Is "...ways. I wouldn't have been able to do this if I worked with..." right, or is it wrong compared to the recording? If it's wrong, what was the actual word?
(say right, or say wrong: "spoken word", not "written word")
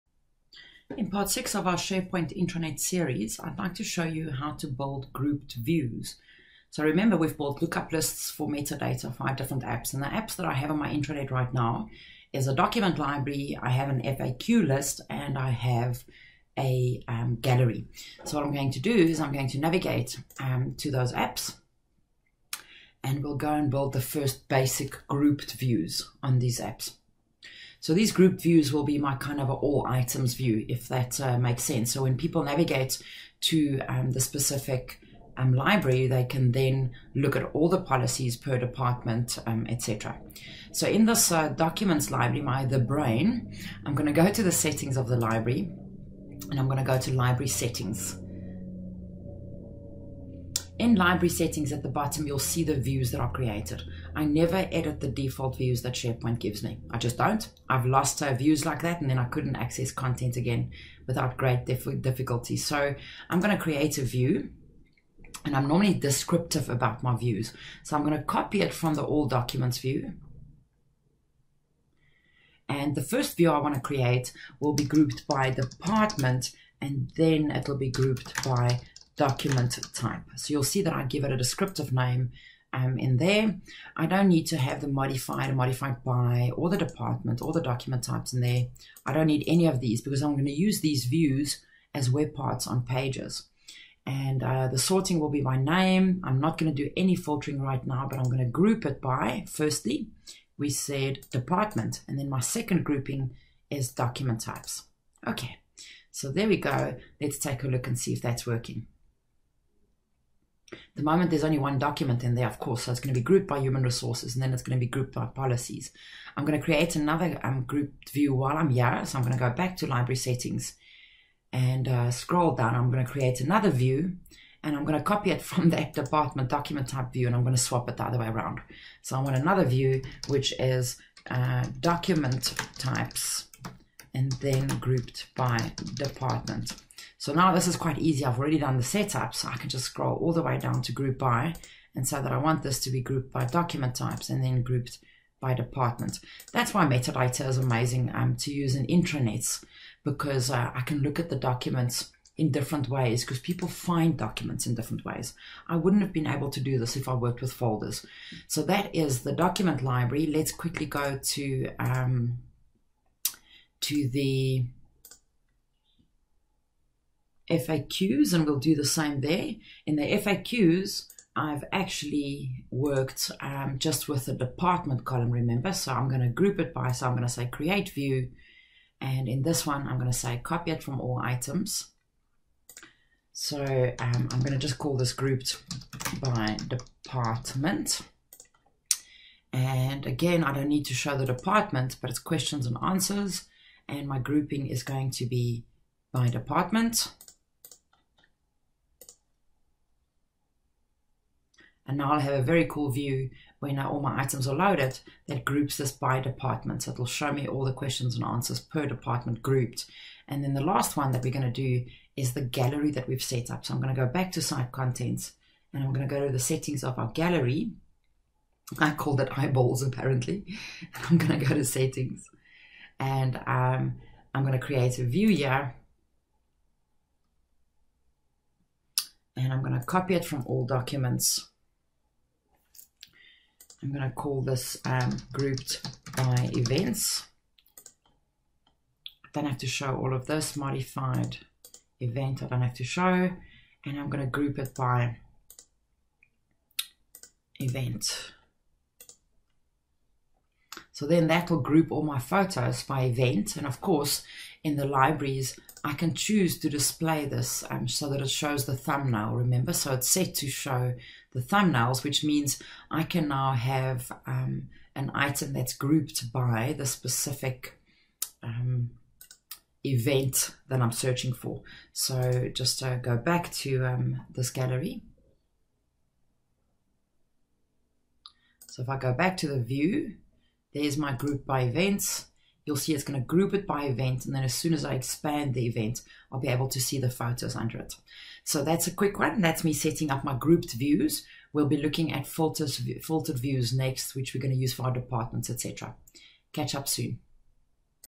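right.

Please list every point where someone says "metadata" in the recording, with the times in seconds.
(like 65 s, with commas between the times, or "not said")
8 s, 146 s.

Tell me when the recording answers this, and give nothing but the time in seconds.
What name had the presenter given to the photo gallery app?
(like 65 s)
219 s.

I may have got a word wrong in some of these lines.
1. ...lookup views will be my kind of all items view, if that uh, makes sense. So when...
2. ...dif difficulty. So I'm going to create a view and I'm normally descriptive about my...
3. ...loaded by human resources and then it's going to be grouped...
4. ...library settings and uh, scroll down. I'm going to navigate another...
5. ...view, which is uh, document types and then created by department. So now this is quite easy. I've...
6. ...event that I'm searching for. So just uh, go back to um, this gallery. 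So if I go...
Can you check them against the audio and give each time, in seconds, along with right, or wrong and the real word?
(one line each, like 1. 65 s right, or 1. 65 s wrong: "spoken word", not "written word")
1. 28 s wrong: "group", not "lookup"
2. 61 s right
3. 113 s wrong: "grouped", not "loaded"
4. 119 s wrong: "create", not "navigate"
5. 129 s wrong: "grouped", not "created"
6. 269 s right.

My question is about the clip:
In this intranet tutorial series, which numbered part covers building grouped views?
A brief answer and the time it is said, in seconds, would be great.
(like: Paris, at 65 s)
6, at 1 s.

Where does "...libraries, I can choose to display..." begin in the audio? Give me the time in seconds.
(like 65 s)
254 s.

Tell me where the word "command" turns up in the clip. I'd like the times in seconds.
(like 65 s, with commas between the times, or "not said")
not said.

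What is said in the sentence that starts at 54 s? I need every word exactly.
I never edit the default views that SharePoint gives me.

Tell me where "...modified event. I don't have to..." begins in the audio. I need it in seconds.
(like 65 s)
240 s.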